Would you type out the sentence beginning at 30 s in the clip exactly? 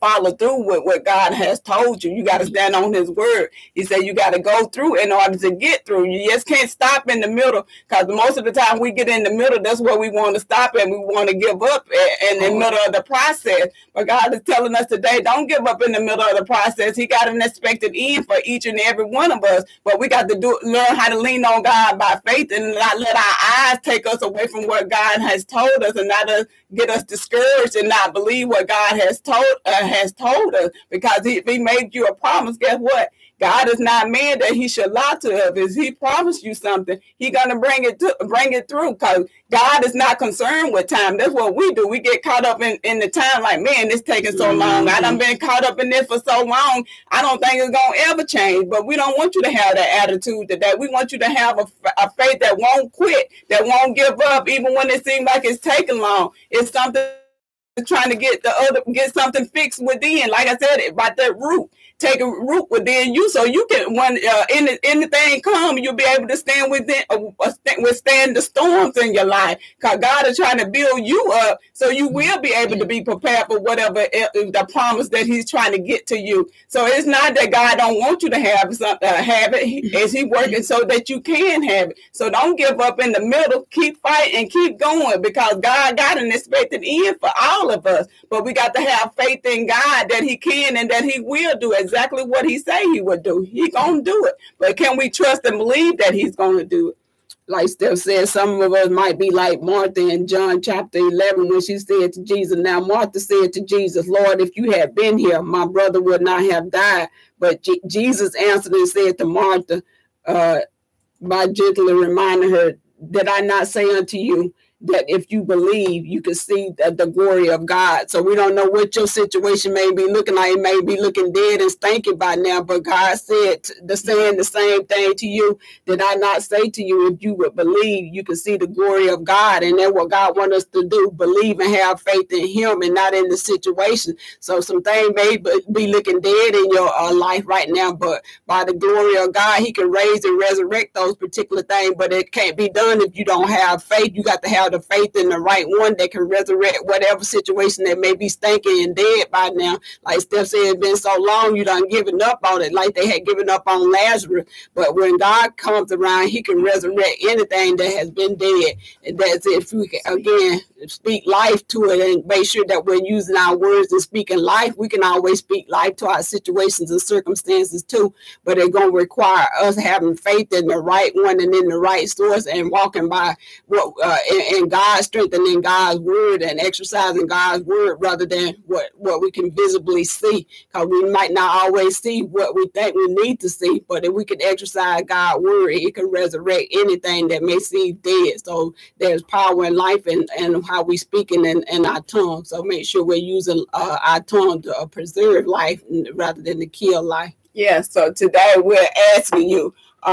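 Because if He made you a promise, guess what?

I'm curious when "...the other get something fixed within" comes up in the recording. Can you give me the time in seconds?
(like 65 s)
58 s.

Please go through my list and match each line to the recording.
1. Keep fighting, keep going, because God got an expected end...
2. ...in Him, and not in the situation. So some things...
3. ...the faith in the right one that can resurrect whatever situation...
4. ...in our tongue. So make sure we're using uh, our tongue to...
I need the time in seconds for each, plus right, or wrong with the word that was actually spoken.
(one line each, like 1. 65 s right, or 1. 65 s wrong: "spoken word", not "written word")
1. 83 s right
2. 132 s right
3. 144 s right
4. 191 s right.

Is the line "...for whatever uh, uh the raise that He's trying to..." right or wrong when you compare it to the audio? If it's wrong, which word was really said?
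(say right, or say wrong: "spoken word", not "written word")
wrong: "promise", not "raise".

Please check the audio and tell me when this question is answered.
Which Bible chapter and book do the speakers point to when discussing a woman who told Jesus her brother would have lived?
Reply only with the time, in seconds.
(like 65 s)
100 s.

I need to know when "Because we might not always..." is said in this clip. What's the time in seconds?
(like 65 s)
180 s.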